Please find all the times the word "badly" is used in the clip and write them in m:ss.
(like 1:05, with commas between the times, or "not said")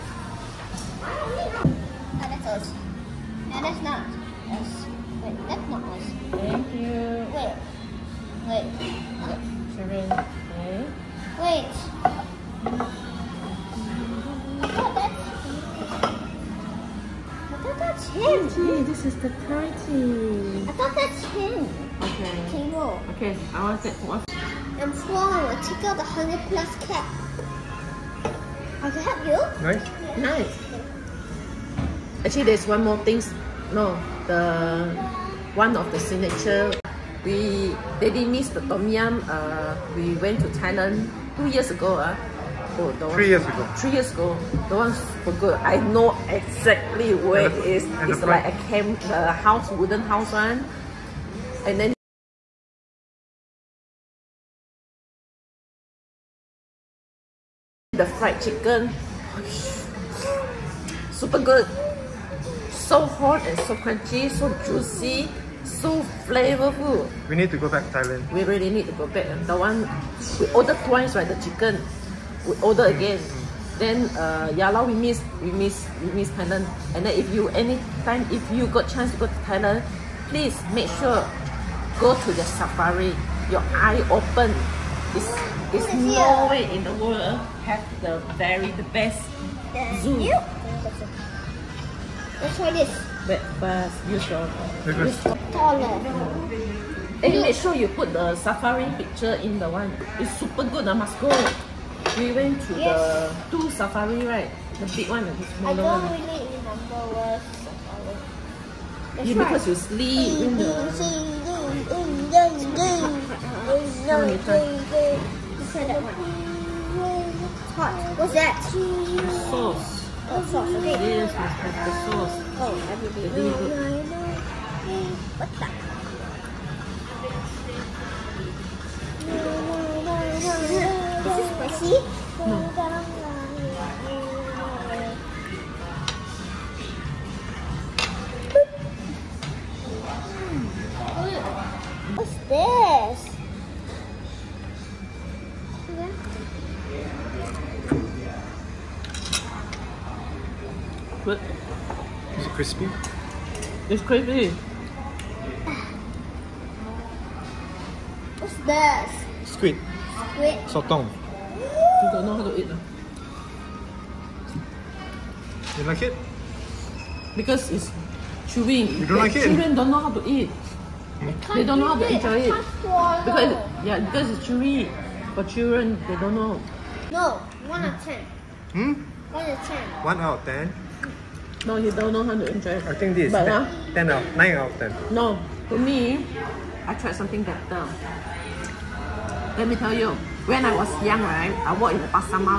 not said.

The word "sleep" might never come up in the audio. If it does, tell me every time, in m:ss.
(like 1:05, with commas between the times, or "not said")
1:49.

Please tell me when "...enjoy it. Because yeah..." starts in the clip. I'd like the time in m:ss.
2:52.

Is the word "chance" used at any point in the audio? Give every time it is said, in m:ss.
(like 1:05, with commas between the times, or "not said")
1:18.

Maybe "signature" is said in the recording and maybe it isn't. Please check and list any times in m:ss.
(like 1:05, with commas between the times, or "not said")
0:35.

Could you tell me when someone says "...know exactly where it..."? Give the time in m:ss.
0:45.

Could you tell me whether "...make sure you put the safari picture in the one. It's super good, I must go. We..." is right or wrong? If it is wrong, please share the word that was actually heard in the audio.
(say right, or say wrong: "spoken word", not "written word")
right.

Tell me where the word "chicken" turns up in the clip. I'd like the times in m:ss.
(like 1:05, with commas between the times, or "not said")
0:58, 1:11.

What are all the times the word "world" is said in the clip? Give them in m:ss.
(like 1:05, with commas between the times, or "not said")
1:27.